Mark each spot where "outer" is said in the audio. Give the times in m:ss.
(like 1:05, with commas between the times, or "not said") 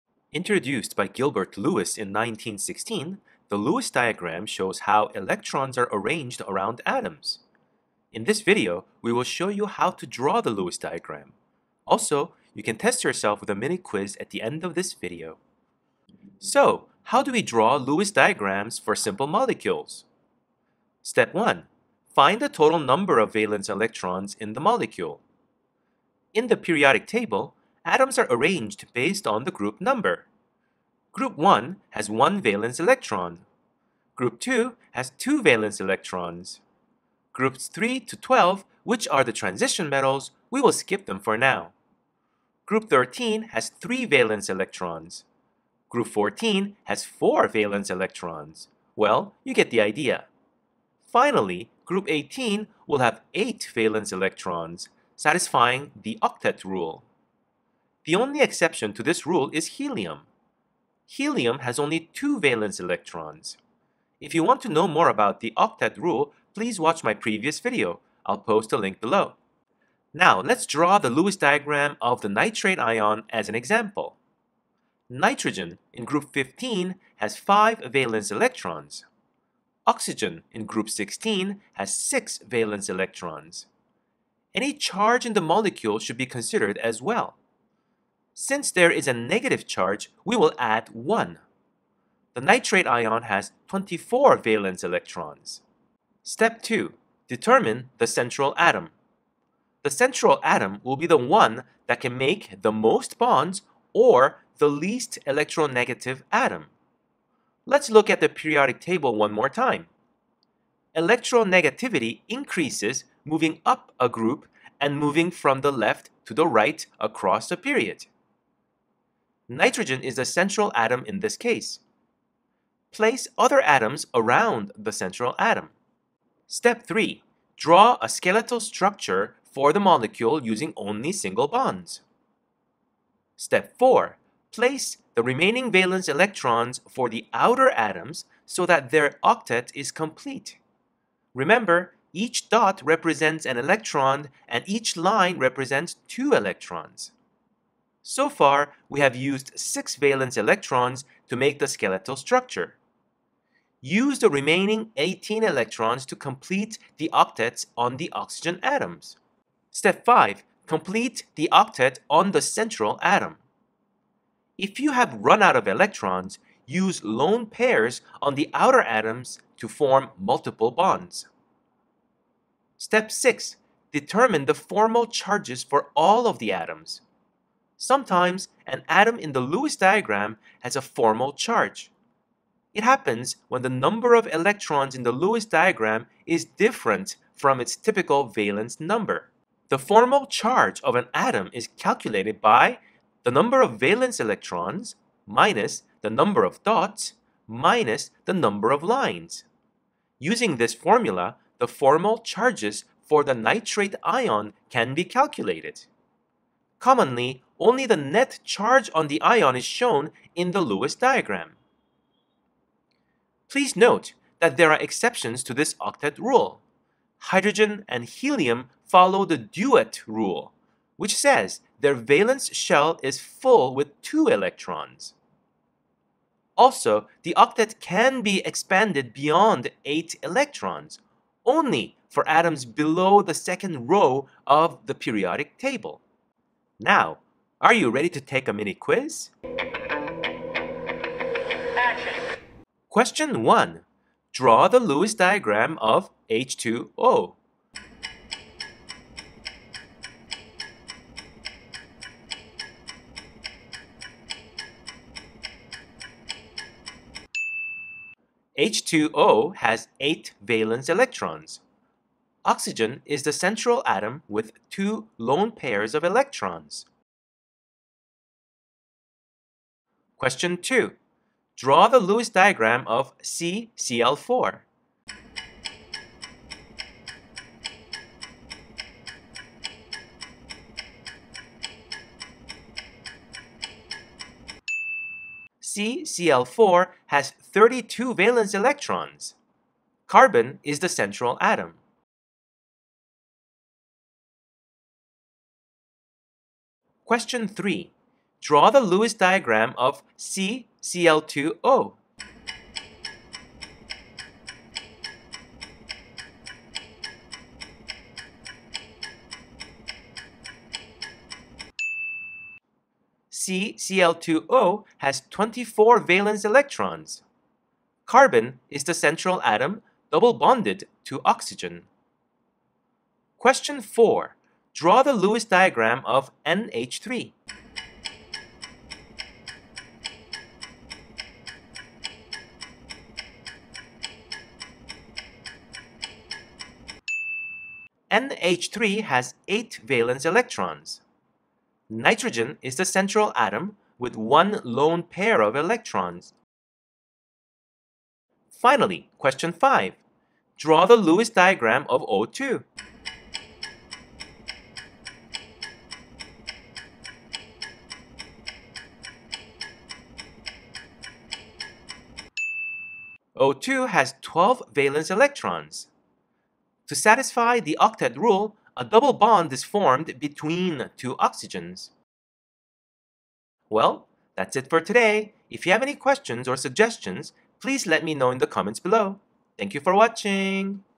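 2:17, 2:48.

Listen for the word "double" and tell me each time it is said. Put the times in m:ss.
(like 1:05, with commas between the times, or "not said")
5:20, 6:08.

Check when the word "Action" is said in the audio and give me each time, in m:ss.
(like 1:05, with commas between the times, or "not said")
4:01.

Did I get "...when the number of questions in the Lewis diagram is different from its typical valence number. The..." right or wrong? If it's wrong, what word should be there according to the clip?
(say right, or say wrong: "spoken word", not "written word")
wrong: "electrons", not "questions".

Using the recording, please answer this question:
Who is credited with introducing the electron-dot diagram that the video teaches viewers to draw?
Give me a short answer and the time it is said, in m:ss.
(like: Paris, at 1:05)
Gilbert Lewis, at 0:01.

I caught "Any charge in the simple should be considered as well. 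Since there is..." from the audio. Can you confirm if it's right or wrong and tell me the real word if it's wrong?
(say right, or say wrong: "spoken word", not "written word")
wrong: "molecule", not "simple".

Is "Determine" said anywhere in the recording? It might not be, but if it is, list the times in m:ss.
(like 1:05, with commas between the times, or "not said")
1:37, 2:53.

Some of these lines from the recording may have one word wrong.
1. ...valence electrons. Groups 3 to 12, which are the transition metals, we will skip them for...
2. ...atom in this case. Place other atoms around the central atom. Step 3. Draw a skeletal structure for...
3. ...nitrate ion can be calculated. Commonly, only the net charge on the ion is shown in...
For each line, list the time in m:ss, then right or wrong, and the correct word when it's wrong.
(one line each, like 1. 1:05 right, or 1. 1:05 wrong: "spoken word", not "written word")
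1. 0:35 right
2. 2:00 right
3. 3:23 right.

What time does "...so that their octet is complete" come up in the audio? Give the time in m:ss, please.
2:18.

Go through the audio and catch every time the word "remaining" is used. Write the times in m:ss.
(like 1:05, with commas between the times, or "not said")
2:15, 2:34.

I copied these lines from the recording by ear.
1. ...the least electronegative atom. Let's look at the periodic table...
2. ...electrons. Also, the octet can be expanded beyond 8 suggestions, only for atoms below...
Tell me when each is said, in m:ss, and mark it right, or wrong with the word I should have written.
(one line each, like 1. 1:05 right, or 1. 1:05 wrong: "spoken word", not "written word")
1. 1:44 right
2. 3:44 wrong: "electrons", not "suggestions".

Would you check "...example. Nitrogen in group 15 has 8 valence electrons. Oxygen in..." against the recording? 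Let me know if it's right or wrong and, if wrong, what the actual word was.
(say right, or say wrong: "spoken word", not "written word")
wrong: "5", not "8".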